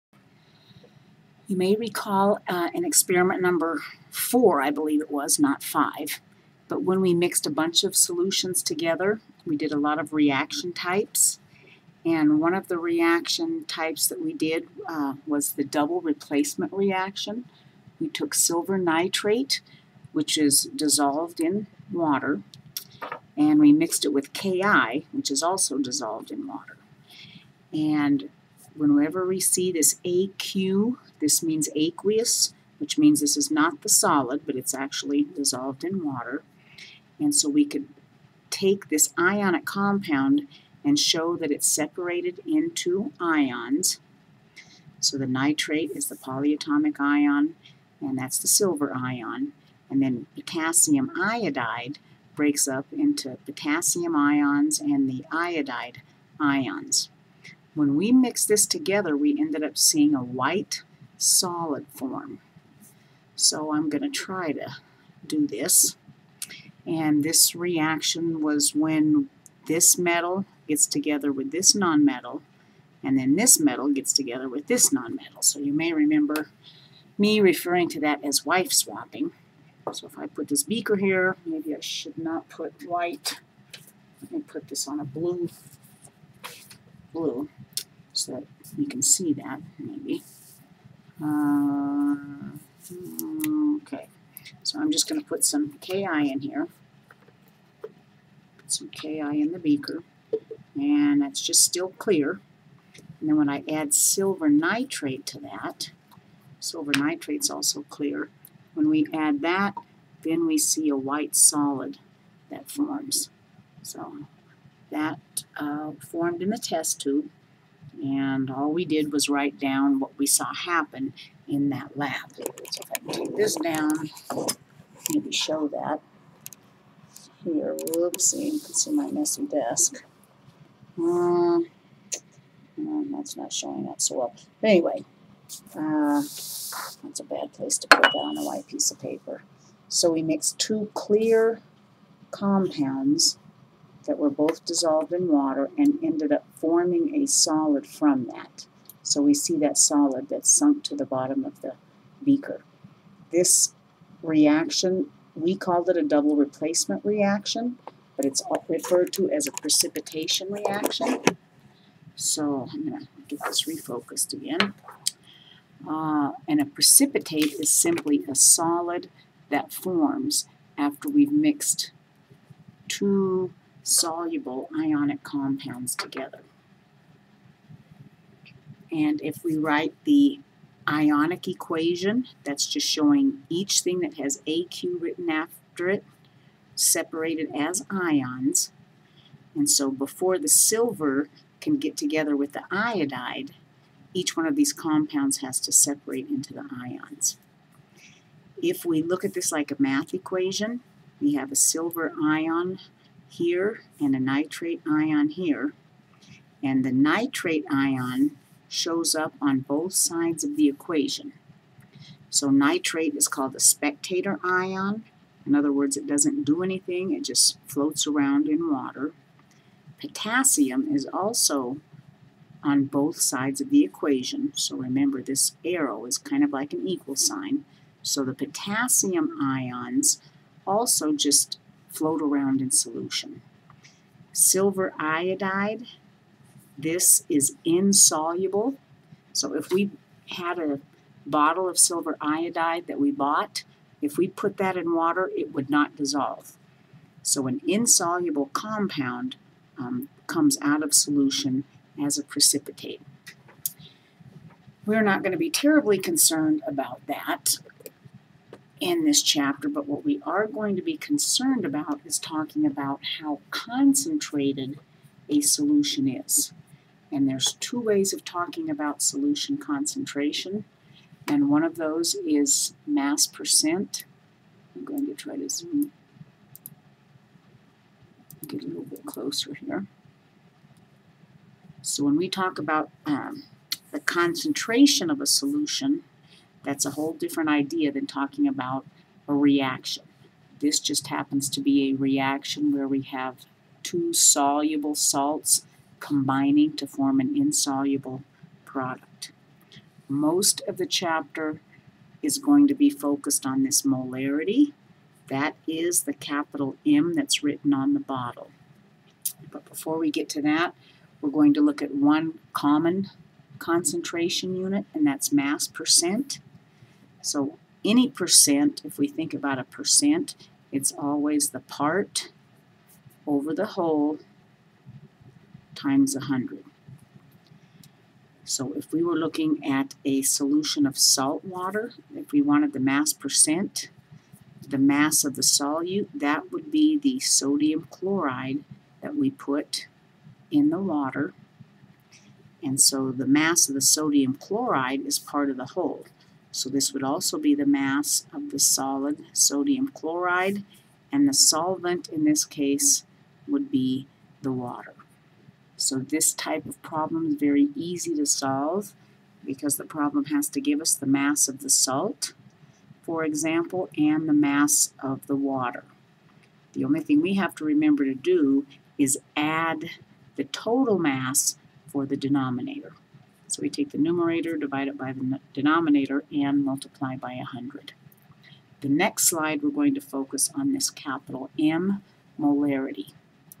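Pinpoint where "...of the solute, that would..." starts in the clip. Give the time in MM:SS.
05:35.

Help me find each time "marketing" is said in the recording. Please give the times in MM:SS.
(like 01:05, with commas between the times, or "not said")
not said.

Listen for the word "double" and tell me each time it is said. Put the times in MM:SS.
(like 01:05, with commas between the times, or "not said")
00:15, 02:36.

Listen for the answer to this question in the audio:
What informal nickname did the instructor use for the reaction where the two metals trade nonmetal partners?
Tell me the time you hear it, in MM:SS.
01:18.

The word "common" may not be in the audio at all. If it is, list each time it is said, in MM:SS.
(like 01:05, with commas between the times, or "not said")
05:12.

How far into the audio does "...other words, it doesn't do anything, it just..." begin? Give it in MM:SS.
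03:35.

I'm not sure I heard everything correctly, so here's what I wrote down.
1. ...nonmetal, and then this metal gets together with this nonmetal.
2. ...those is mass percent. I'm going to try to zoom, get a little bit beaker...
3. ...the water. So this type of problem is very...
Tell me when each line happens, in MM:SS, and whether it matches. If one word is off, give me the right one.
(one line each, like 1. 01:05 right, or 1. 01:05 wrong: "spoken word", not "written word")
1. 01:11 right
2. 04:31 wrong: "closer", not "beaker"
3. 05:54 right.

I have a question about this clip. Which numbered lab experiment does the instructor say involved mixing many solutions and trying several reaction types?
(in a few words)
4.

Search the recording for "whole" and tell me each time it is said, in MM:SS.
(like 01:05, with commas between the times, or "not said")
04:46, 05:23, 05:45.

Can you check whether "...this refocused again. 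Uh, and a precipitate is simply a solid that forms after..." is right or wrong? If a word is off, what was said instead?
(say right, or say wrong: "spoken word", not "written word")
right.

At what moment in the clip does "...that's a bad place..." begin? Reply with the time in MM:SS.
02:16.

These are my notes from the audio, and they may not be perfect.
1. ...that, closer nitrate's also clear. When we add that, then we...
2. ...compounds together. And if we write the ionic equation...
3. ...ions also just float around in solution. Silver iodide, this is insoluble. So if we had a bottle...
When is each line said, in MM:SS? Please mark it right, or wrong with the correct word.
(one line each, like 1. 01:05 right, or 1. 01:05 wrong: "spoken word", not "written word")
1. 01:45 wrong: "silver", not "closer"
2. 02:55 right
3. 03:49 right.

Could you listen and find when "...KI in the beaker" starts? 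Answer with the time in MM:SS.
01:38.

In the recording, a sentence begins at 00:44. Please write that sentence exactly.
So the nitrate is the polyatomic ion, and that's the silver ion.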